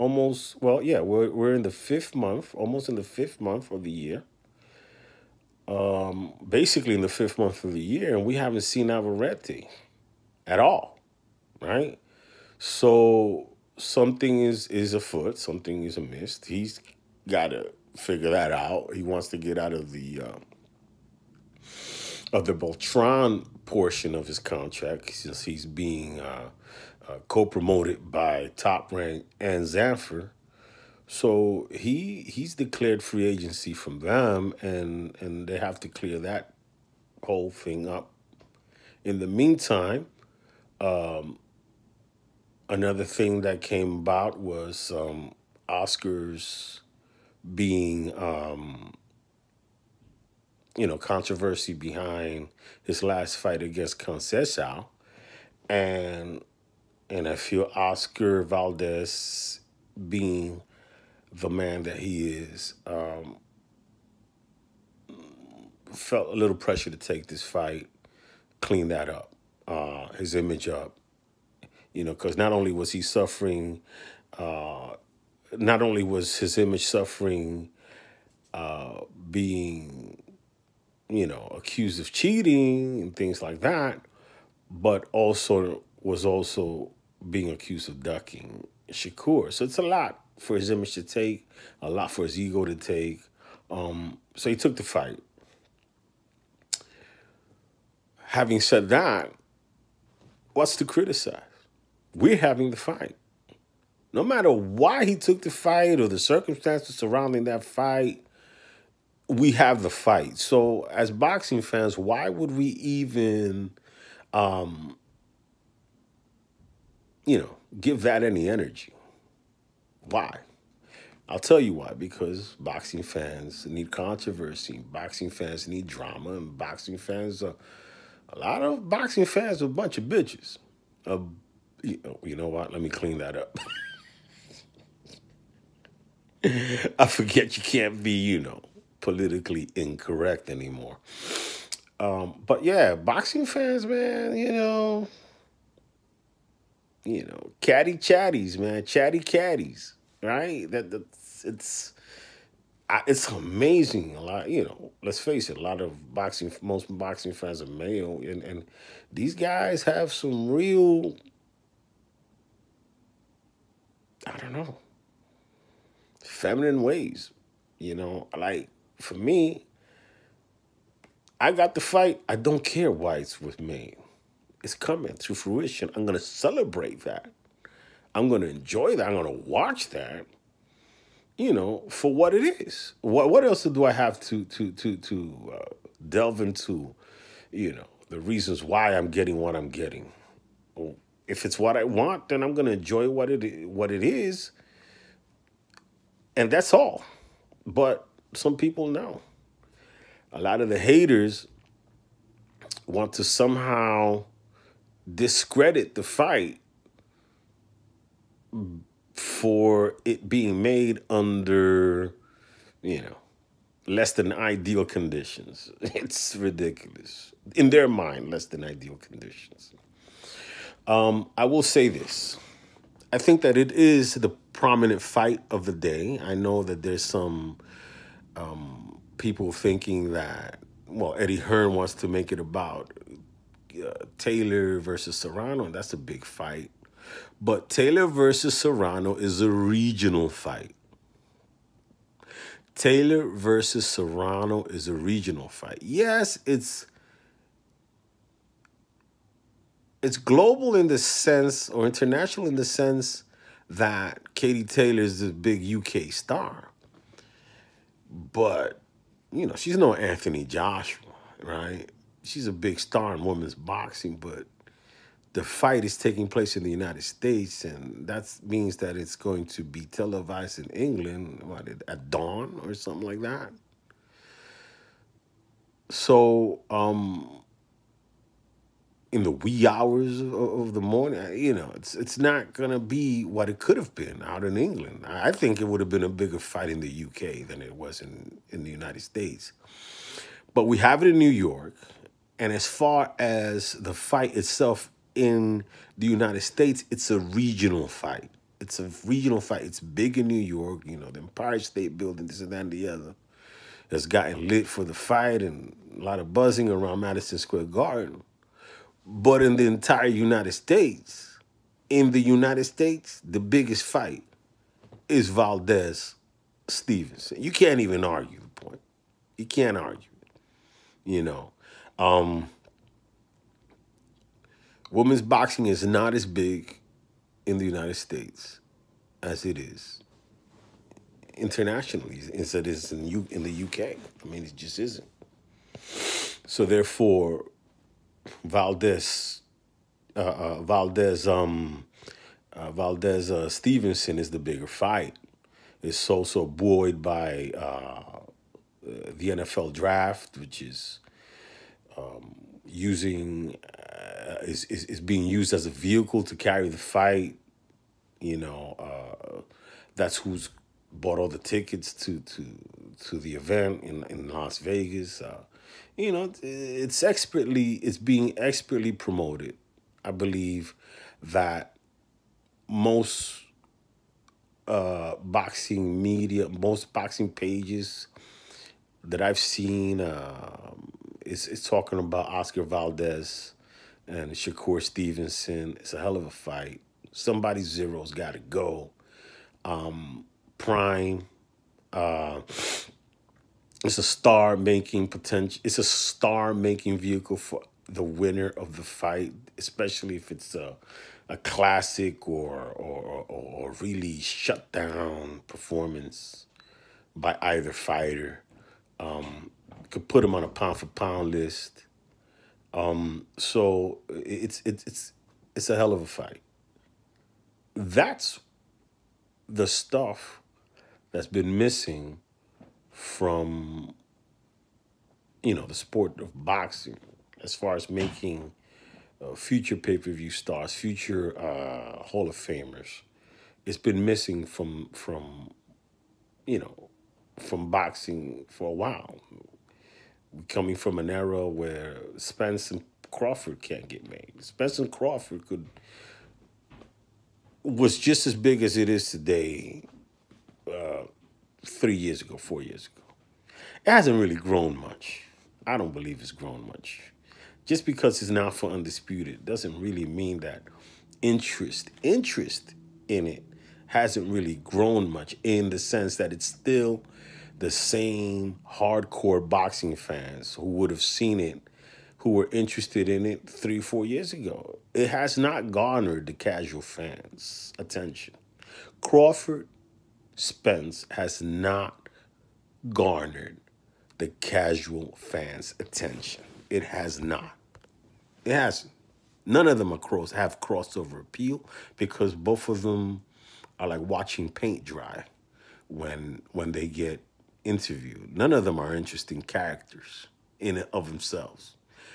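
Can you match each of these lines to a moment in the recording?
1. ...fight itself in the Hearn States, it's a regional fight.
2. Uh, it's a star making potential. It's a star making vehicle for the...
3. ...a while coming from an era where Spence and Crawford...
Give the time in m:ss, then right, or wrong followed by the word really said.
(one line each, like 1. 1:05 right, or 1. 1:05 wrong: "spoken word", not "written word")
1. 4:53 wrong: "United", not "Hearn"
2. 6:31 right
3. 7:18 right.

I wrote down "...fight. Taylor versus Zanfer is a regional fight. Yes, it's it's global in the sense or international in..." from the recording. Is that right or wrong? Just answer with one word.
wrong.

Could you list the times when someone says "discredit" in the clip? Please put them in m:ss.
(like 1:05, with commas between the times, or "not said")
3:25.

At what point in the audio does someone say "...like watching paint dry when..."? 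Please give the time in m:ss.
8:13.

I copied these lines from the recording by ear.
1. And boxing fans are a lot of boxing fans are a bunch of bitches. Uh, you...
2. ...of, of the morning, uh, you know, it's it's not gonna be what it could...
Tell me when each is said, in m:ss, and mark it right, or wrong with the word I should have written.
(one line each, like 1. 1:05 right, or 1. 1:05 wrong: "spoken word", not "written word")
1. 2:06 right
2. 4:40 right.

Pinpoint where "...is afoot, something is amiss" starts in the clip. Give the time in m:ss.
0:14.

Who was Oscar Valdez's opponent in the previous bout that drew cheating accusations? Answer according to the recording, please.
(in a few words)
Conceição.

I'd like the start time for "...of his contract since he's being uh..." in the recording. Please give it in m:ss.
0:24.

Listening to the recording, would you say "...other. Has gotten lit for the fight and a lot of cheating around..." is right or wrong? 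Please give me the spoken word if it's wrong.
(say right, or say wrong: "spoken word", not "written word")
wrong: "buzzing", not "cheating".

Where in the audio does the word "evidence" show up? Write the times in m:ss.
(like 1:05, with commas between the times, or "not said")
not said.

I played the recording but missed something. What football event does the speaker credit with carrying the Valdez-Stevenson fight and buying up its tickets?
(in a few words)
NFL draft.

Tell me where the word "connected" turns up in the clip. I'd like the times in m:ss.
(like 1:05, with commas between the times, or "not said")
not said.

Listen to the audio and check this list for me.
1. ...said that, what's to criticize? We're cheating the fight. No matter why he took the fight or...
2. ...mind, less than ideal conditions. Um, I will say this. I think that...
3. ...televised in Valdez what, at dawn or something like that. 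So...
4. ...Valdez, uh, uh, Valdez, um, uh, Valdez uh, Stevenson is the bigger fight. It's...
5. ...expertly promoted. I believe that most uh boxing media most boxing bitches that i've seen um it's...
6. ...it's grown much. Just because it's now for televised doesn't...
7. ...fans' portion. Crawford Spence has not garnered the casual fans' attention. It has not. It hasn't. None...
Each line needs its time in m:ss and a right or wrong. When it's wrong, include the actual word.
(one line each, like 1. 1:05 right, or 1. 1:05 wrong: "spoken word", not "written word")
1. 1:38 wrong: "having", not "cheating"
2. 3:37 right
3. 4:29 wrong: "England", not "Valdez"
4. 5:38 right
5. 6:08 wrong: "pages", not "bitches"
6. 7:36 wrong: "undisputed", not "televised"
7. 7:56 wrong: "attention", not "portion".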